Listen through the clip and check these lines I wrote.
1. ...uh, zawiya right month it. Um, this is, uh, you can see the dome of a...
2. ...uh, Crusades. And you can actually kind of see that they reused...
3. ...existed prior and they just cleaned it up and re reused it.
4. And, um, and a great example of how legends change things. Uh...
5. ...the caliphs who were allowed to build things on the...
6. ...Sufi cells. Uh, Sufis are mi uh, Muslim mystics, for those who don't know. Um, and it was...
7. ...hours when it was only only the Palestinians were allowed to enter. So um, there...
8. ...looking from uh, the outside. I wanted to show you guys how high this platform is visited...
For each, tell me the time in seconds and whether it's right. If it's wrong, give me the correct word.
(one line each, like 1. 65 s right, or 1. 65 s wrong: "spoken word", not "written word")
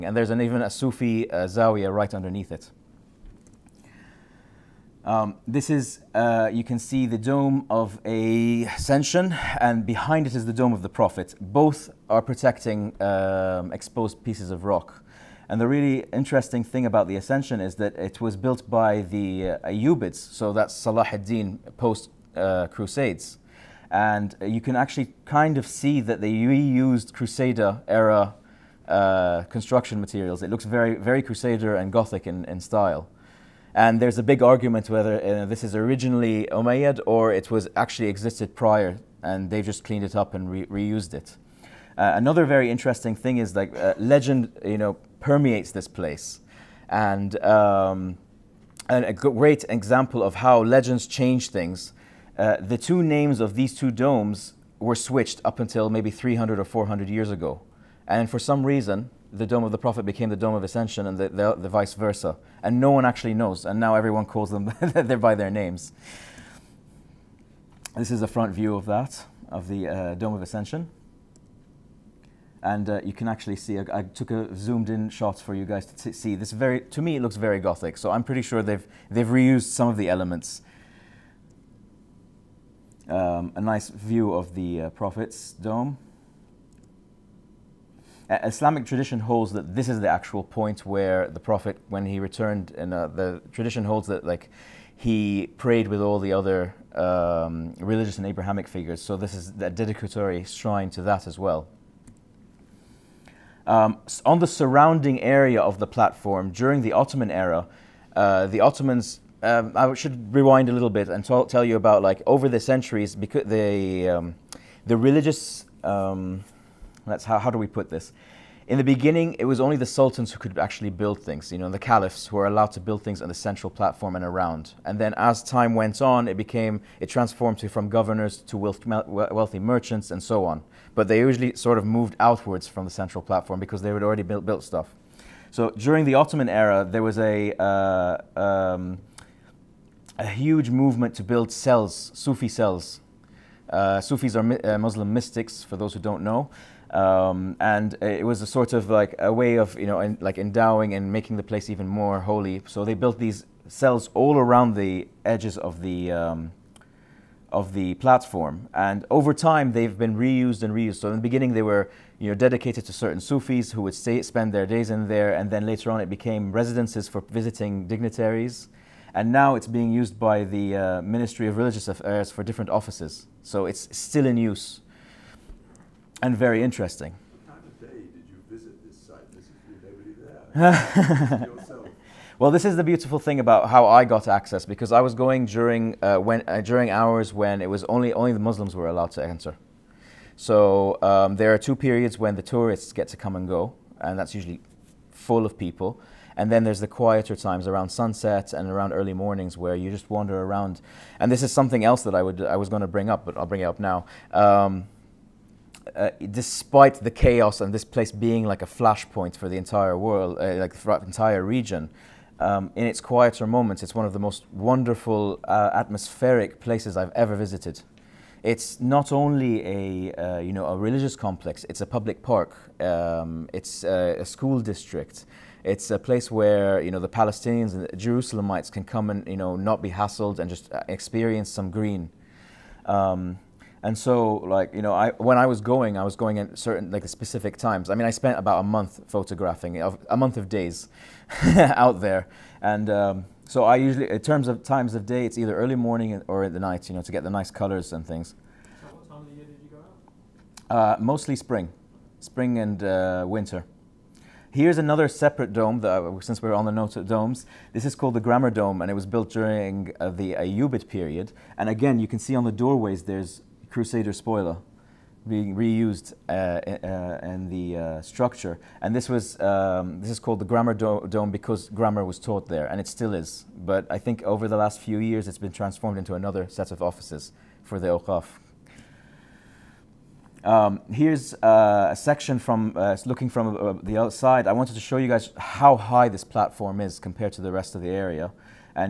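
1. 1 s wrong: "underneath", not "month"
2. 22 s right
3. 38 s right
4. 46 s right
5. 121 s right
6. 142 s right
7. 186 s wrong: "Muslims", not "Palestinians"
8. 283 s wrong: "compared", not "visited".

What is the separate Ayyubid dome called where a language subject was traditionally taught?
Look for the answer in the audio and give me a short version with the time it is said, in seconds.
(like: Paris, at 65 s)
Grammar Dome, at 258 s.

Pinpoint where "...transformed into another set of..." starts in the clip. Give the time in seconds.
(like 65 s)
275 s.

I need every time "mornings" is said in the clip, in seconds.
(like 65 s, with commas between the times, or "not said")
199 s, 245 s.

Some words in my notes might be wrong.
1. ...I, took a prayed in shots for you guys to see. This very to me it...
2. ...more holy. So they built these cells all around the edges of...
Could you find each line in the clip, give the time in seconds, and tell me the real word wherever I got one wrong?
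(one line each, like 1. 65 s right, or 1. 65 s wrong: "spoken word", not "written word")
1. 73 s wrong: "zoomed", not "prayed"
2. 151 s right.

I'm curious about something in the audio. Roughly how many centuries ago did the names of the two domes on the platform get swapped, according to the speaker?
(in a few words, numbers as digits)
300 or 400 years.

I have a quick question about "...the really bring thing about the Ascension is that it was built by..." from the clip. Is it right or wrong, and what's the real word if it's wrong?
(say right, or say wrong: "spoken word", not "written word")
wrong: "interesting", not "bring".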